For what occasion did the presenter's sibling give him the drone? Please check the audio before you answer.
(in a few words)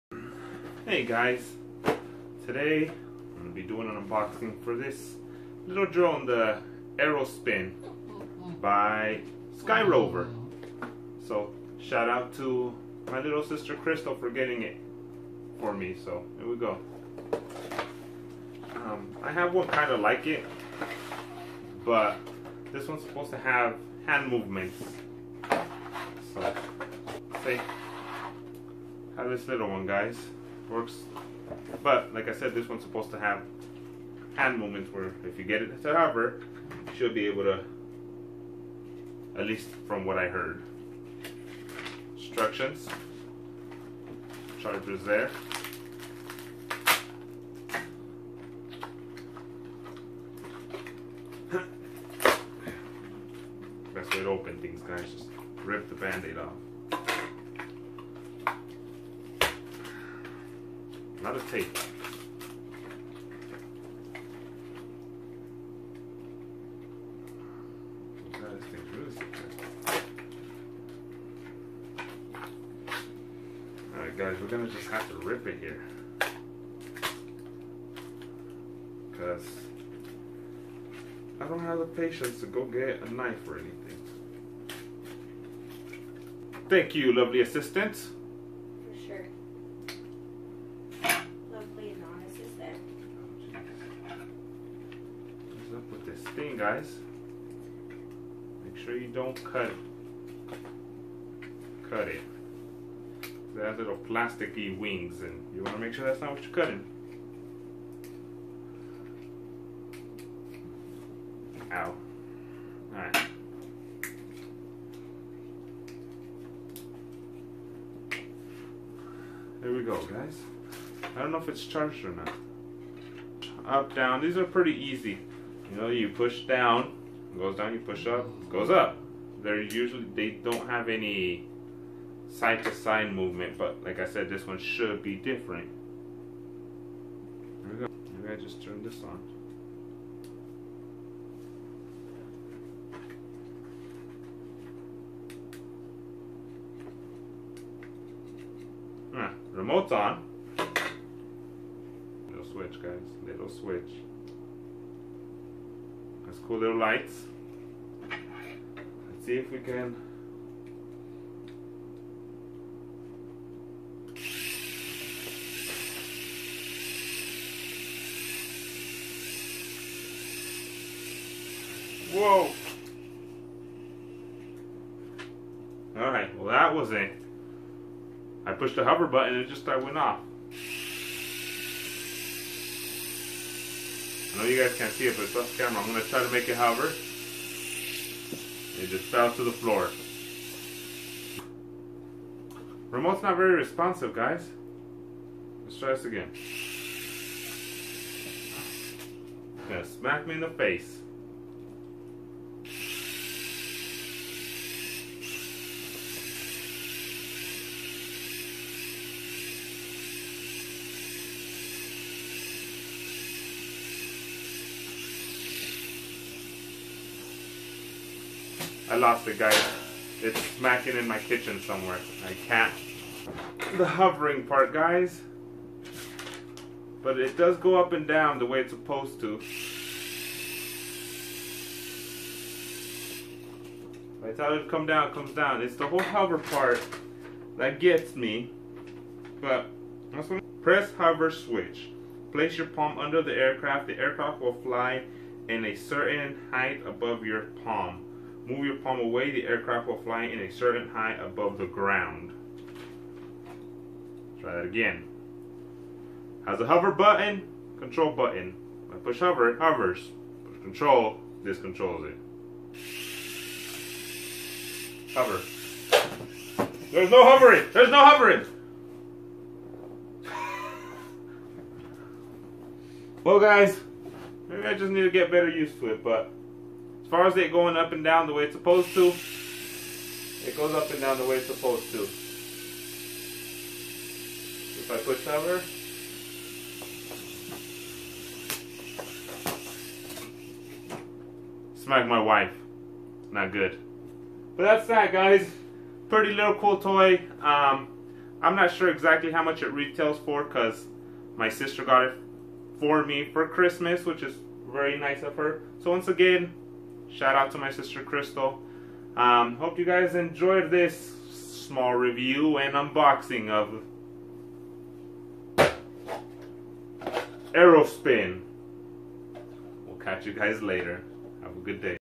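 Christmas.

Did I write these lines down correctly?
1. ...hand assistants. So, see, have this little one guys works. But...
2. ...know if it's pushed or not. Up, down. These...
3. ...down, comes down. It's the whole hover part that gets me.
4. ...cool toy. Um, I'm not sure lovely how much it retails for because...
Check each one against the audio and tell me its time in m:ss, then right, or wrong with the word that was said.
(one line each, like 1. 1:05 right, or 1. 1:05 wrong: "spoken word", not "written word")
1. 0:24 wrong: "movements", not "assistants"
2. 2:01 wrong: "charged", not "pushed"
3. 3:54 right
4. 4:56 wrong: "exactly", not "lovely".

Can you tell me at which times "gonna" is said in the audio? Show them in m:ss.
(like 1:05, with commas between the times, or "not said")
1:14.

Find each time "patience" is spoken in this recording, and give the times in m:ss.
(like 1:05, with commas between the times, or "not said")
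1:21.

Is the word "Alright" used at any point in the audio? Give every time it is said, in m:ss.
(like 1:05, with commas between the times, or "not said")
1:13, 1:52, 2:55.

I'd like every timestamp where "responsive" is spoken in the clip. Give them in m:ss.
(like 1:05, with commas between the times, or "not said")
3:13.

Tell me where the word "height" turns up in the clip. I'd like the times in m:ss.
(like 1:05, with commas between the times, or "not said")
4:06, 4:10.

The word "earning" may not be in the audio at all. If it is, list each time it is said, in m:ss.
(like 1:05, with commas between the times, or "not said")
not said.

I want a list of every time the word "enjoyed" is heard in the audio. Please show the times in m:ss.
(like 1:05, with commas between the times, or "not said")
5:10.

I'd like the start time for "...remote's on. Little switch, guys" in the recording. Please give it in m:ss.
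2:29.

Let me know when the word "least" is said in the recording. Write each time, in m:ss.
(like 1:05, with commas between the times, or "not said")
0:39.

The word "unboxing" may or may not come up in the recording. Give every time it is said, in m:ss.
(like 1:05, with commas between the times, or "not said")
0:04, 5:12.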